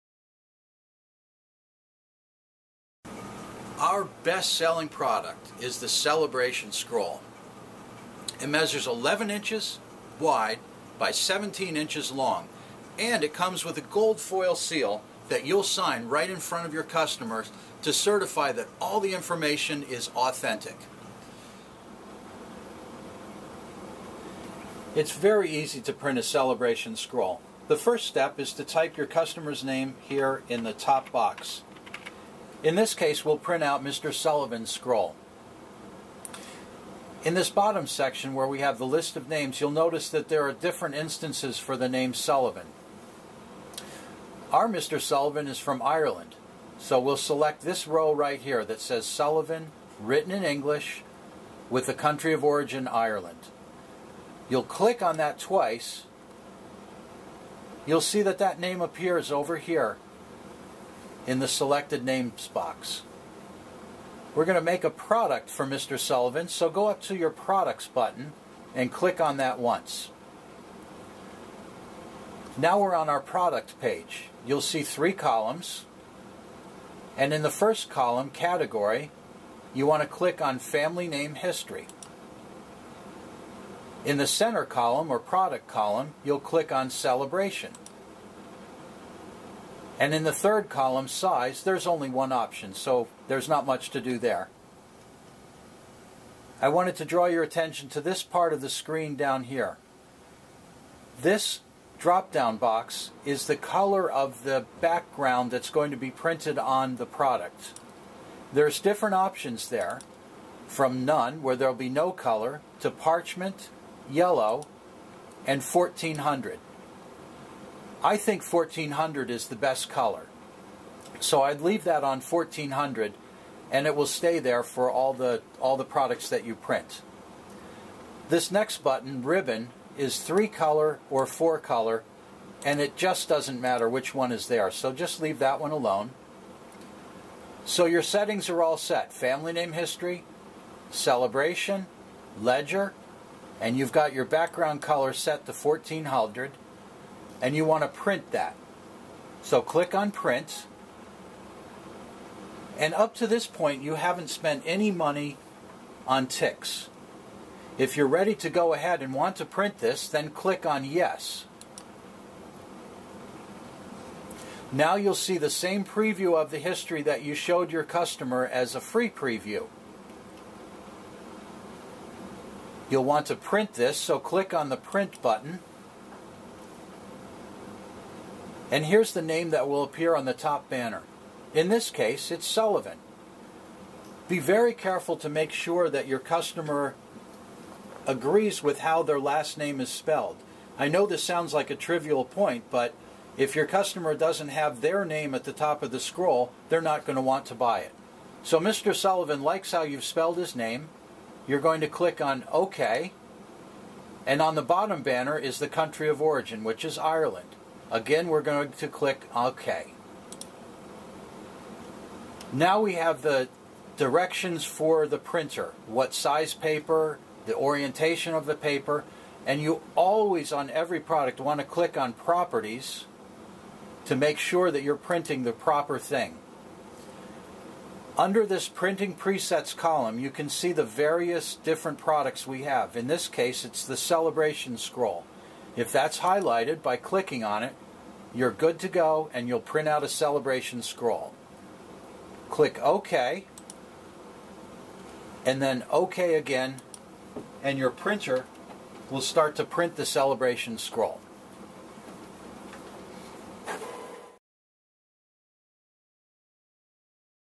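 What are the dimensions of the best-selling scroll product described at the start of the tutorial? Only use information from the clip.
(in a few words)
11 by 17 inches.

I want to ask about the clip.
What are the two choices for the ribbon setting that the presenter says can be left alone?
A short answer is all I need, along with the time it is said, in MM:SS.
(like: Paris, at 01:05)
three color or four color, at 02:10.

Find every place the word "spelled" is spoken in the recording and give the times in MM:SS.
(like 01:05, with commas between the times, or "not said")
03:09, 03:20.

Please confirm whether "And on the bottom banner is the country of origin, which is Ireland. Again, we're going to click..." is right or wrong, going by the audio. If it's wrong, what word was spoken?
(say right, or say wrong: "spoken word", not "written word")
right.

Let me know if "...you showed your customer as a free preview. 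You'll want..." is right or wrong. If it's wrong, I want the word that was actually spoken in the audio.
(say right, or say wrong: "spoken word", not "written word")
right.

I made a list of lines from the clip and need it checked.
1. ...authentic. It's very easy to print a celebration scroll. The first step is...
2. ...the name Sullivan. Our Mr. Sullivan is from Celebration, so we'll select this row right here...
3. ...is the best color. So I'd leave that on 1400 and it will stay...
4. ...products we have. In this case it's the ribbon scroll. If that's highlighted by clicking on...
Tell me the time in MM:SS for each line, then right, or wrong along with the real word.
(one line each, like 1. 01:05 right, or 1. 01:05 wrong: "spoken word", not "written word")
1. 00:20 right
2. 00:41 wrong: "Ireland", not "Celebration"
3. 01:59 right
4. 03:51 wrong: "celebration", not "ribbon".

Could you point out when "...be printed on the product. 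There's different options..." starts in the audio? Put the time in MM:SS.
01:45.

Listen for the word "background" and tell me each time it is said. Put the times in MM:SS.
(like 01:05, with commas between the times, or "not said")
01:44, 02:24.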